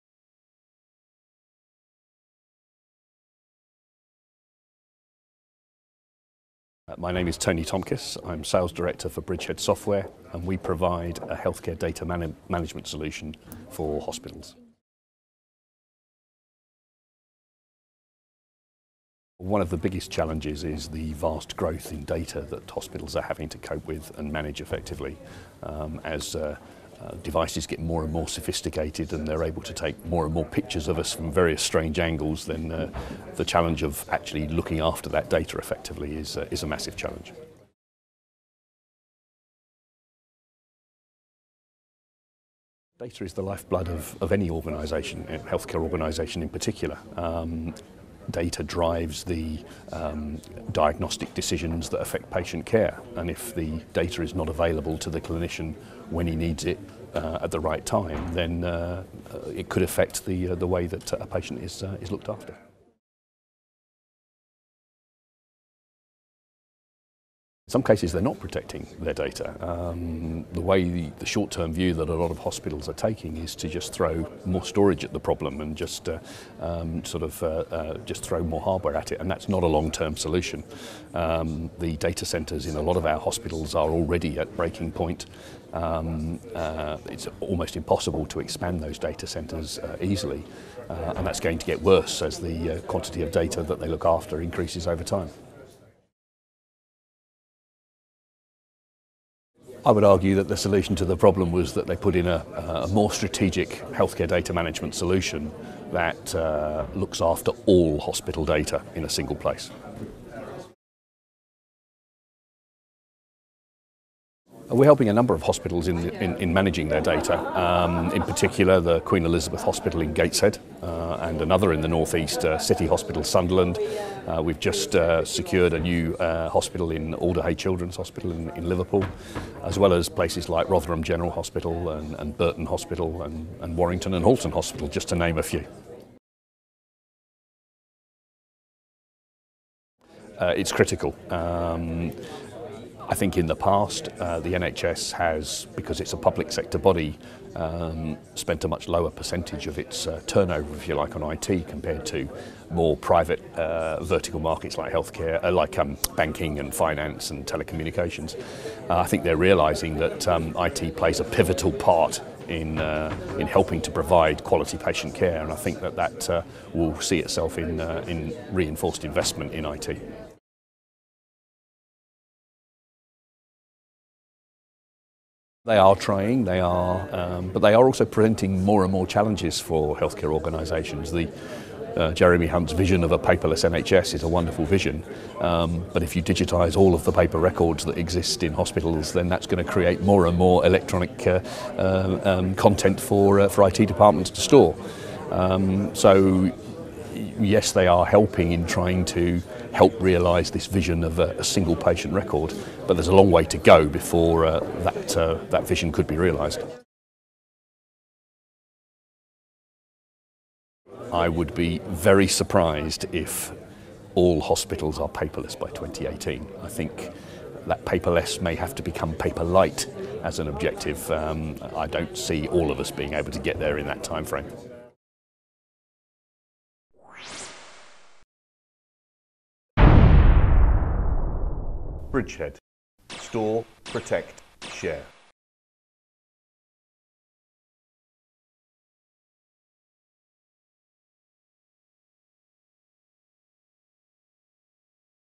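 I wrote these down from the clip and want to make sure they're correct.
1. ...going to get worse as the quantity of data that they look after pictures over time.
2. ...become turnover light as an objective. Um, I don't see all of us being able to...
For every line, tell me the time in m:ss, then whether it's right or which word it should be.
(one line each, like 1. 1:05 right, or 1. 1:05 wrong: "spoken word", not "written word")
1. 1:31 wrong: "increases", not "pictures"
2. 3:38 wrong: "paper", not "turnover".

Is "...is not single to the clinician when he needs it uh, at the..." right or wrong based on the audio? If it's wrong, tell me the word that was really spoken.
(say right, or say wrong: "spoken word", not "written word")
wrong: "available", not "single".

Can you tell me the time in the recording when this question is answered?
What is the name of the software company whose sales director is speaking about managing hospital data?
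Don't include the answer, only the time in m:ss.
0:09.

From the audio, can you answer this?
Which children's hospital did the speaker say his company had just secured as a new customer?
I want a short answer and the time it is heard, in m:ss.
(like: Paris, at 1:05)
Alder Hey Children's Hospital, at 2:07.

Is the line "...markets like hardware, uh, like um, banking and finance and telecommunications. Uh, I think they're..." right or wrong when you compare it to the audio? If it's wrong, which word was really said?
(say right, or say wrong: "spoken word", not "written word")
wrong: "healthcare", not "hardware".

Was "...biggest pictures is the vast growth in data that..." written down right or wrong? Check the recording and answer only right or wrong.
wrong.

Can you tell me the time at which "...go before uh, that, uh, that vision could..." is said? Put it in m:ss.
3:23.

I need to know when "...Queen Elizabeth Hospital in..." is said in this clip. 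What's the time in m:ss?
1:59.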